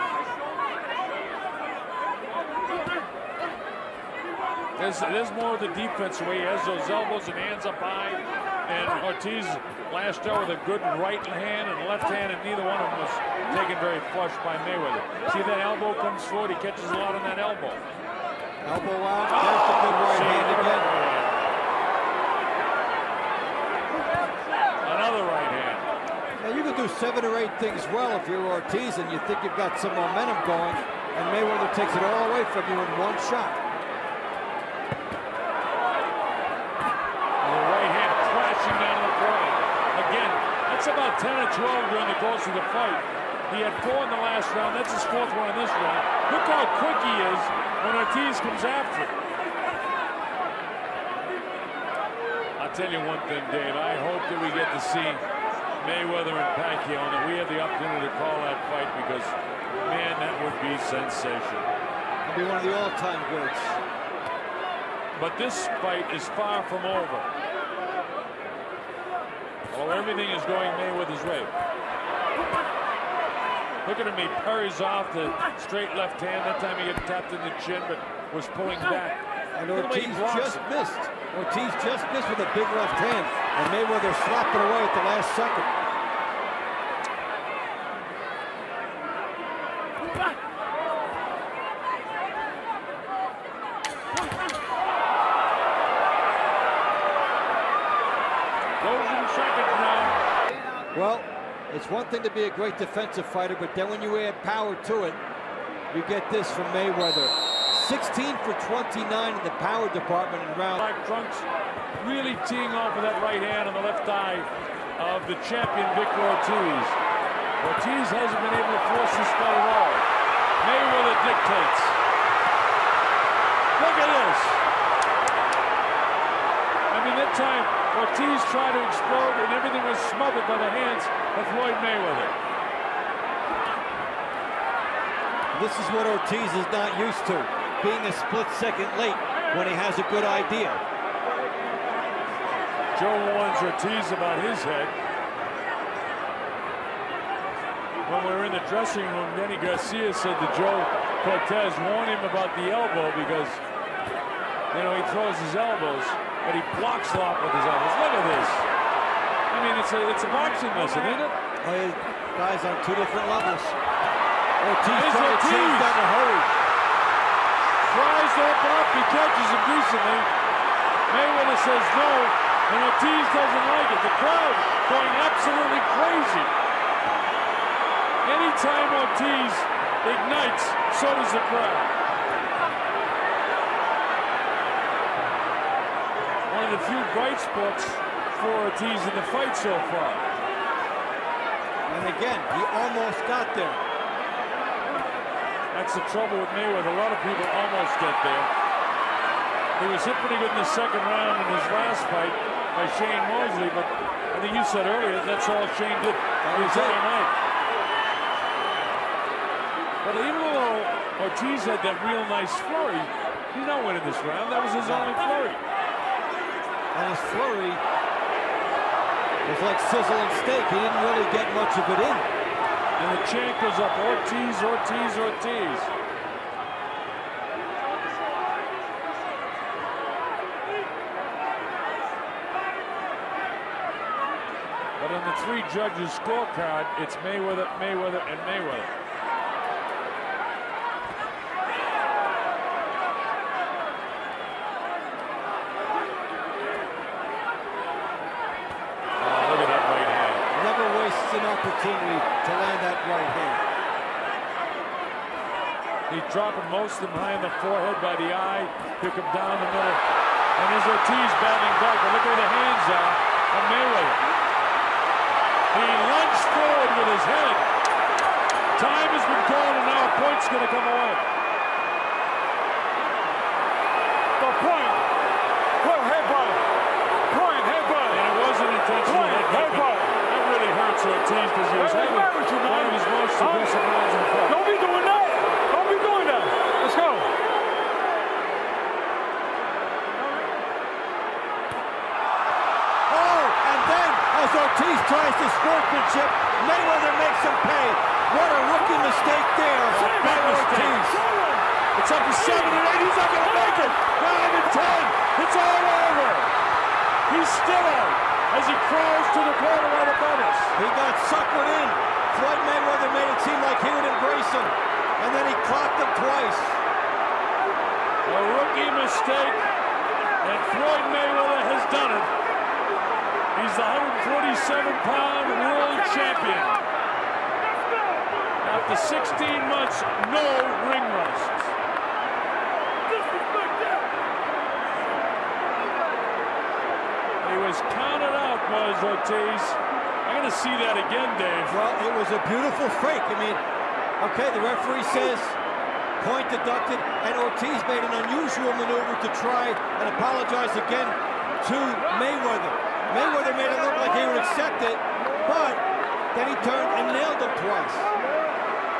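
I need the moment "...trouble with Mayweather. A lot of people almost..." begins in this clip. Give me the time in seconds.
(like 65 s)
196 s.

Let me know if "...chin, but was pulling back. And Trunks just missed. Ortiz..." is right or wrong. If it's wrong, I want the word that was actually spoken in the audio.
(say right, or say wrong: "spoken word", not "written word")
wrong: "Ortiz", not "Trunks".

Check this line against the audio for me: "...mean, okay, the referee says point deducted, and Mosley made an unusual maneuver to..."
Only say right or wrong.
wrong.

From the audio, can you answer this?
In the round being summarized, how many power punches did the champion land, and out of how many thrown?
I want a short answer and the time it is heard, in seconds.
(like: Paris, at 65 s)
16 for 29, at 107 s.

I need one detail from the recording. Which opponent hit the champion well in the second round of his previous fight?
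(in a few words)
Shane Mosley.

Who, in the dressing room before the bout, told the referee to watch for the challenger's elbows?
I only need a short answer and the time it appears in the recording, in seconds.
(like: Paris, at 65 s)
Danny Garcia, at 149 s.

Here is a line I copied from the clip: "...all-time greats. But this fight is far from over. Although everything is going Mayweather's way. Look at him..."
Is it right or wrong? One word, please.
right.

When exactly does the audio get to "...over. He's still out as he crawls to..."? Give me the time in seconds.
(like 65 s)
305 s.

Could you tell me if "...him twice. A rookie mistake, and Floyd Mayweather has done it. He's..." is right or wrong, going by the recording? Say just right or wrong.
right.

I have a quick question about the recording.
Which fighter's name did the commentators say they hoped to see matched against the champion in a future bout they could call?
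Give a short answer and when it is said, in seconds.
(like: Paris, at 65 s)
Pacquiao, at 56 s.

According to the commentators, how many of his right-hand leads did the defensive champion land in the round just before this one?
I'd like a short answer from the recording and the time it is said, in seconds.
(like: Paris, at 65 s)
4, at 43 s.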